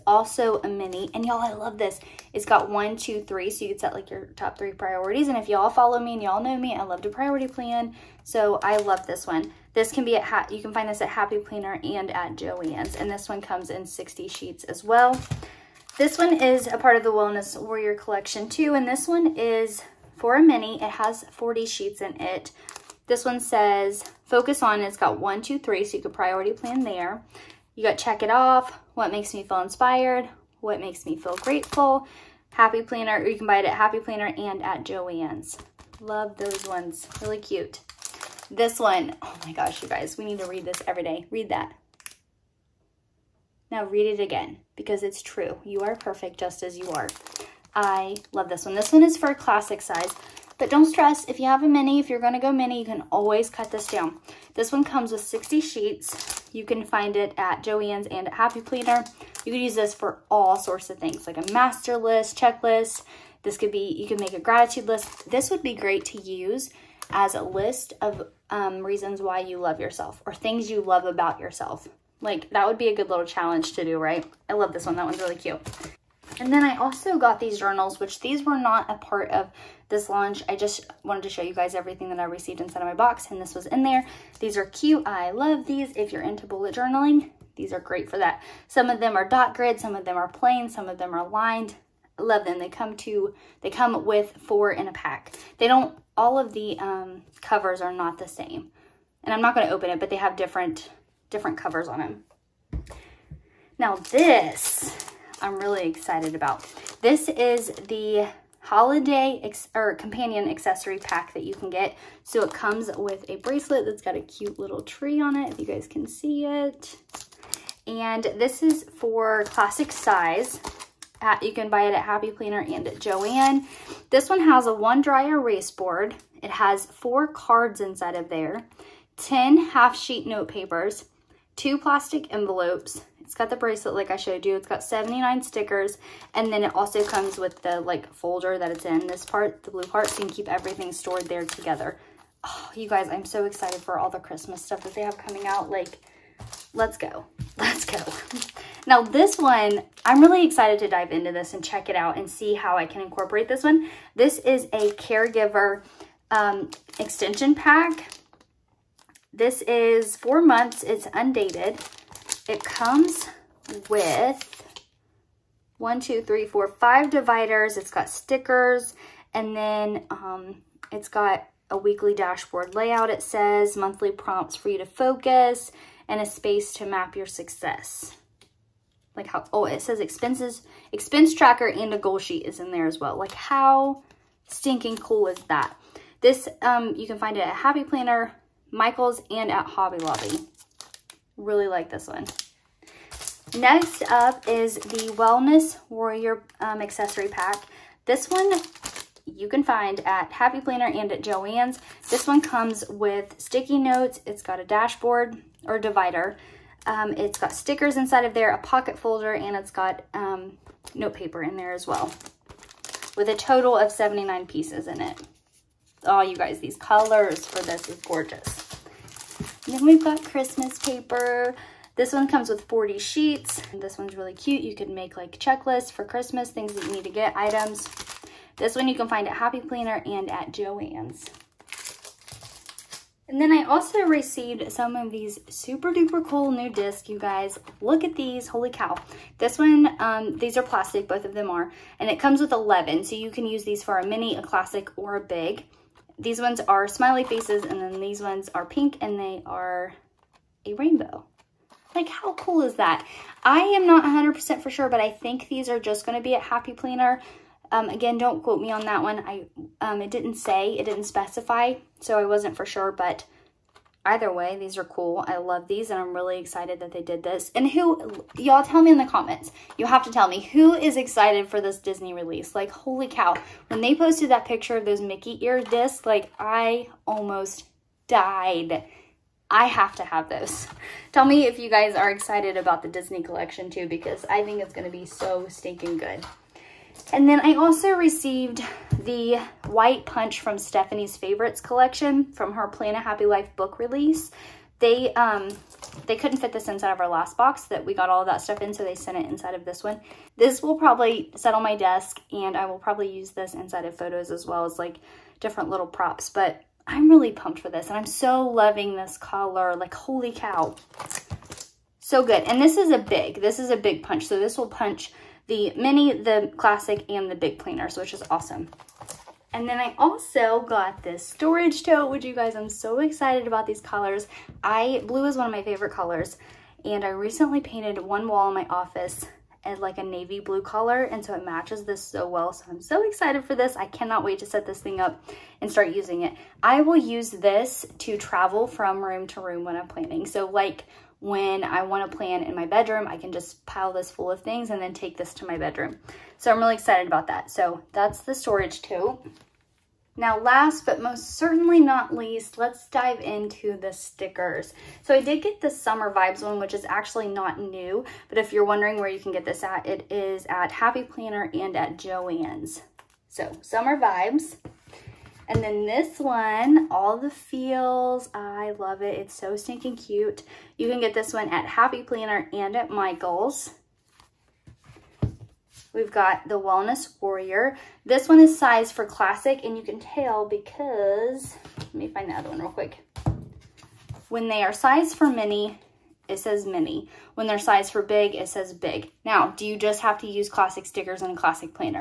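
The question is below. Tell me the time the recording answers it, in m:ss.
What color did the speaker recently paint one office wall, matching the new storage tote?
5:30.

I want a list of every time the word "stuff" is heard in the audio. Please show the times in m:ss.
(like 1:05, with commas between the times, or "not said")
2:24, 4:58.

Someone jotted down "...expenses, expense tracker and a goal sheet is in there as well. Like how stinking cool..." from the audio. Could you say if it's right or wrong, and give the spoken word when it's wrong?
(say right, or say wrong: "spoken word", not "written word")
right.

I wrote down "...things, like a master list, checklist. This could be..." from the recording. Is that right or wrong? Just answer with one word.
right.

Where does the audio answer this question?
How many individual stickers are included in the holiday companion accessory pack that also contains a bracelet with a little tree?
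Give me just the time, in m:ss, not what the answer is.
2:14.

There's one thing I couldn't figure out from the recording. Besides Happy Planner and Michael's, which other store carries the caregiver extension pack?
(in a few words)
Hobby Lobby.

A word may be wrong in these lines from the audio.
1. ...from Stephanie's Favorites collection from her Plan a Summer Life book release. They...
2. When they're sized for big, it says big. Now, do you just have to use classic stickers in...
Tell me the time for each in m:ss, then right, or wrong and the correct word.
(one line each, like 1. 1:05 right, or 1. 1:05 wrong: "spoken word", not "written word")
1. 4:50 wrong: "Happy", not "Summer"
2. 6:27 right.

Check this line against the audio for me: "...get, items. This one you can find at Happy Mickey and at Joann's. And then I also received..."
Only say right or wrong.
wrong.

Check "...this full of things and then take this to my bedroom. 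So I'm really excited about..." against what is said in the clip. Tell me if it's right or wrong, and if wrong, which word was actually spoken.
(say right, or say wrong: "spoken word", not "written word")
right.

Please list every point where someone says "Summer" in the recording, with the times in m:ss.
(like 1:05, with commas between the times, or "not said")
5:55, 6:03.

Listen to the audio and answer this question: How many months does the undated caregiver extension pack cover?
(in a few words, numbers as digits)
4 months.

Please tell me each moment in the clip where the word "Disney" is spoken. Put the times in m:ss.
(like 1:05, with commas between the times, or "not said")
4:31, 4:42.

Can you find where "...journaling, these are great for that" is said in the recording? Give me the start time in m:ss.
1:26.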